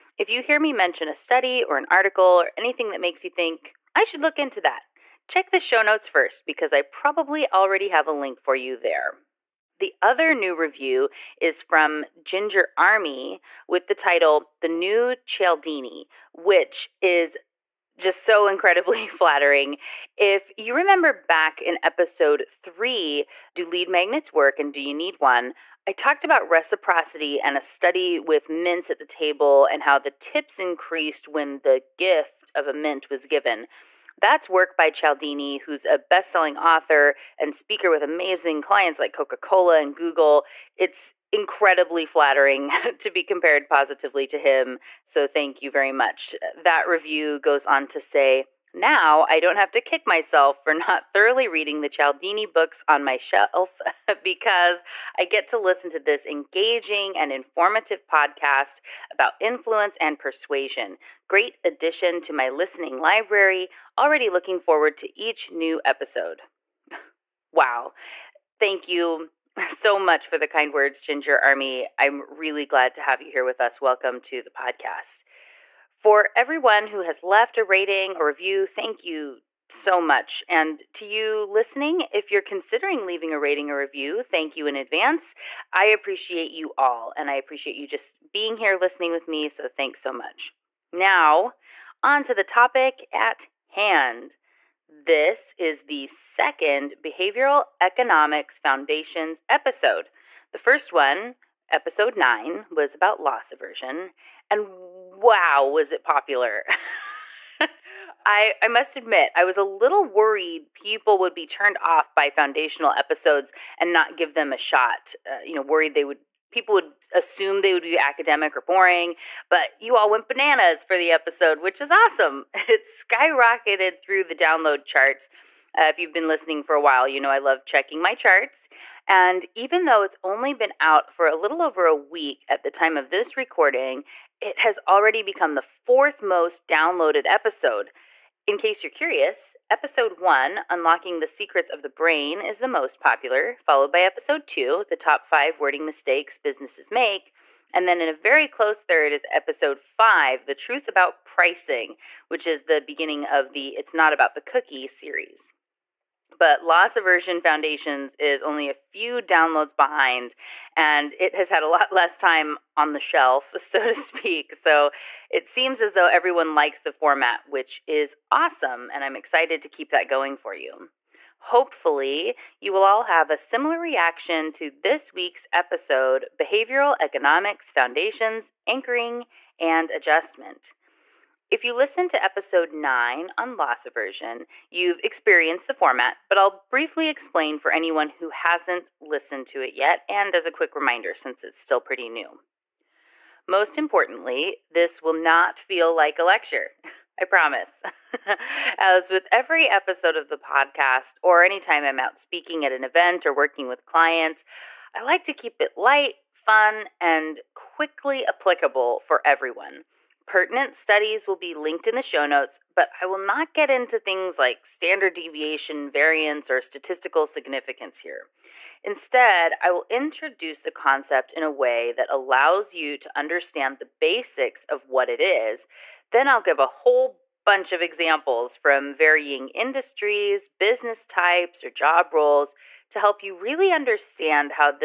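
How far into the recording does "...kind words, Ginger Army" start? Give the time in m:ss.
1:10.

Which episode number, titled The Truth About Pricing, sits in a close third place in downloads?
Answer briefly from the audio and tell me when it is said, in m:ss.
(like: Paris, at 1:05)
5, at 2:29.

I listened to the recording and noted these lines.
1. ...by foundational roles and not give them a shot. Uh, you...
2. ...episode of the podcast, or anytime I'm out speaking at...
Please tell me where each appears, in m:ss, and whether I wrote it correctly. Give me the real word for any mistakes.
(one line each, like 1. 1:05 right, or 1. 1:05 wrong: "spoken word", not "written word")
1. 1:52 wrong: "episodes", not "roles"
2. 3:19 right.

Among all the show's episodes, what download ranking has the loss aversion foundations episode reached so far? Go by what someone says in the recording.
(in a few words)
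Fourth.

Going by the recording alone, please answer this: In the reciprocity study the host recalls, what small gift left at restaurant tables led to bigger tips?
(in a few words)
A mint.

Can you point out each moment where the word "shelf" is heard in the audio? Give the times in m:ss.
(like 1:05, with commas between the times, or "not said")
0:53, 2:42.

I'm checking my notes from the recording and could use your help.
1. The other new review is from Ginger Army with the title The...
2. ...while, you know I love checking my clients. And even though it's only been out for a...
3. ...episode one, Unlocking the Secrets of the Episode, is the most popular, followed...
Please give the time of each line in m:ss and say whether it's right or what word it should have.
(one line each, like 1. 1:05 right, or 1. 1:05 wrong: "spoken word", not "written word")
1. 0:09 right
2. 2:06 wrong: "charts", not "clients"
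3. 2:19 wrong: "Brain", not "Episode".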